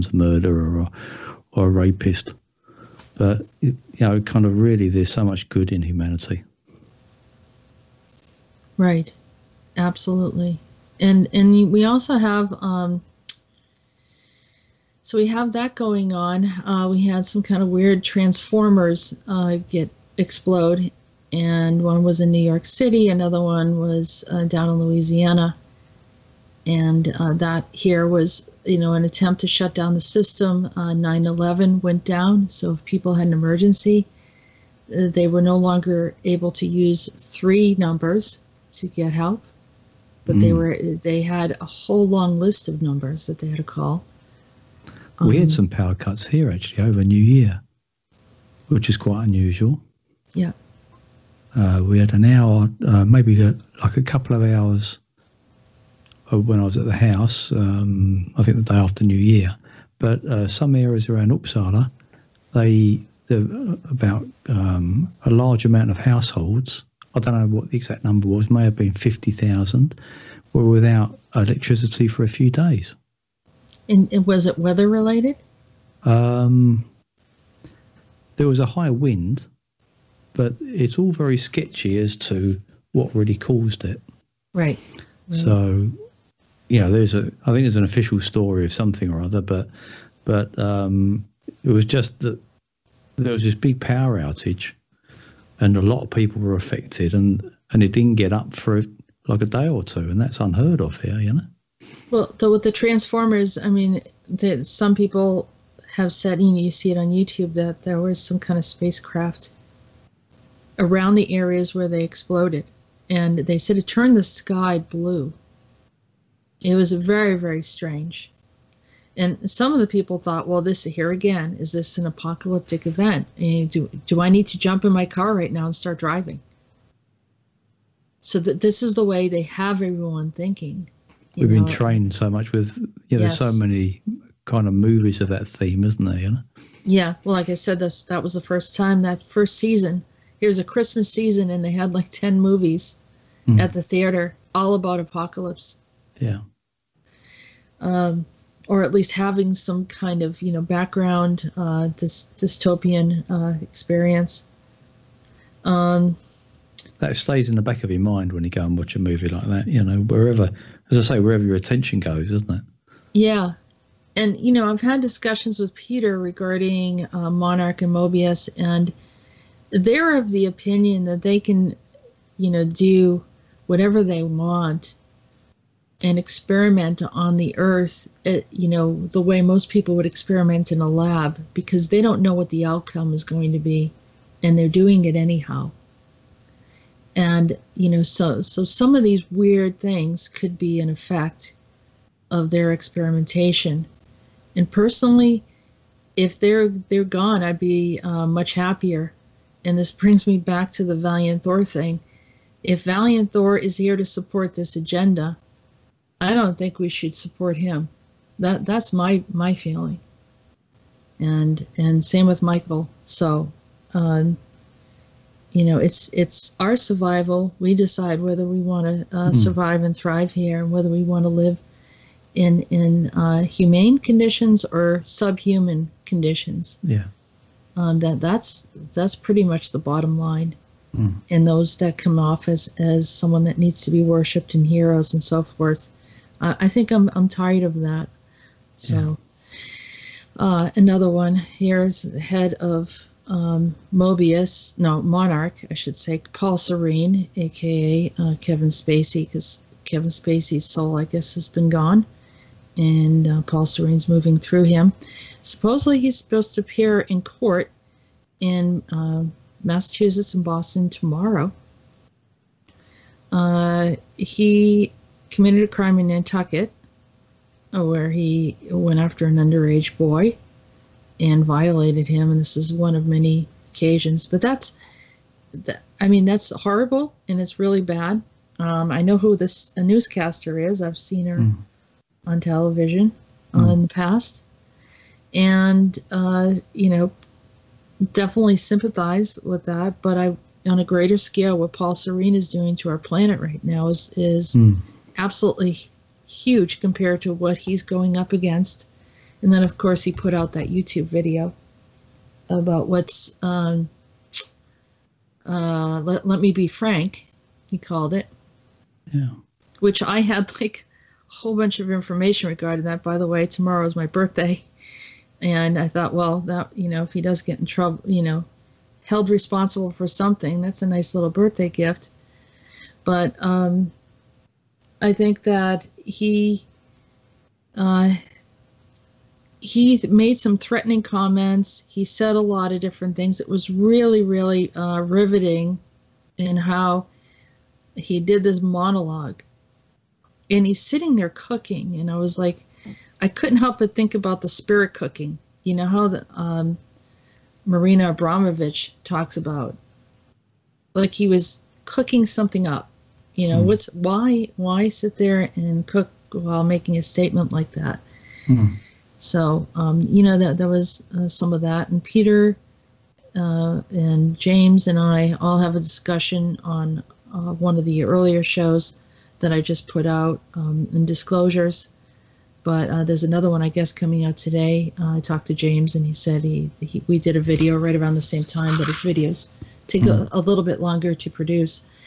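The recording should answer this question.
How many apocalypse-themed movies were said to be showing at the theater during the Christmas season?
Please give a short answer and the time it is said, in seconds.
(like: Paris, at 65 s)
10, at 142 s.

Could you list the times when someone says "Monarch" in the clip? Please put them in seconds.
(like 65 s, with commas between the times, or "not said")
167 s, 245 s.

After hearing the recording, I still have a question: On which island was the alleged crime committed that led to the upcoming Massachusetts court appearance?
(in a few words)
Nantucket.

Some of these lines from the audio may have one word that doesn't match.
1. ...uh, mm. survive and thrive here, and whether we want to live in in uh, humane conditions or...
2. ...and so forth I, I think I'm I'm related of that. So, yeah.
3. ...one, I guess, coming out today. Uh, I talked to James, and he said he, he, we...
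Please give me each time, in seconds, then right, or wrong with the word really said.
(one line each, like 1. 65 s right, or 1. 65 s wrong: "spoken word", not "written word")
1. 219 s right
2. 235 s wrong: "tired", not "related"
3. 373 s right.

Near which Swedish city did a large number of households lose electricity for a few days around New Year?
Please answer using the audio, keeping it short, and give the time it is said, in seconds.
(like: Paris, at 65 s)
Uppsala, at 61 s.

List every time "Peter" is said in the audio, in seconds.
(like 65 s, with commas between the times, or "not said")
165 s, 362 s.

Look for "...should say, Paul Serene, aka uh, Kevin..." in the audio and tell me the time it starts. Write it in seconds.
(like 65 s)
245 s.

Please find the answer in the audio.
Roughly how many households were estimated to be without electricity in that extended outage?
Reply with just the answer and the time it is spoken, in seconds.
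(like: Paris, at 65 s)
50,000, at 68 s.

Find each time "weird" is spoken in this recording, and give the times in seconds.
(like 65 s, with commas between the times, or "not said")
17 s, 189 s.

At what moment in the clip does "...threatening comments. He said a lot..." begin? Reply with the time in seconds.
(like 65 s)
330 s.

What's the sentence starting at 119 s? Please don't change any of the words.
And some of the people thought, well, this here again, is this an apocalyptic event?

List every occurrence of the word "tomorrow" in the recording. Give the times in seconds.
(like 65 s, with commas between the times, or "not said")
260 s, 313 s.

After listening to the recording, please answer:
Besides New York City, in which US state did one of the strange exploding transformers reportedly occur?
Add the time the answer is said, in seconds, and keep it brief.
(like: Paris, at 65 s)
Louisiana, at 24 s.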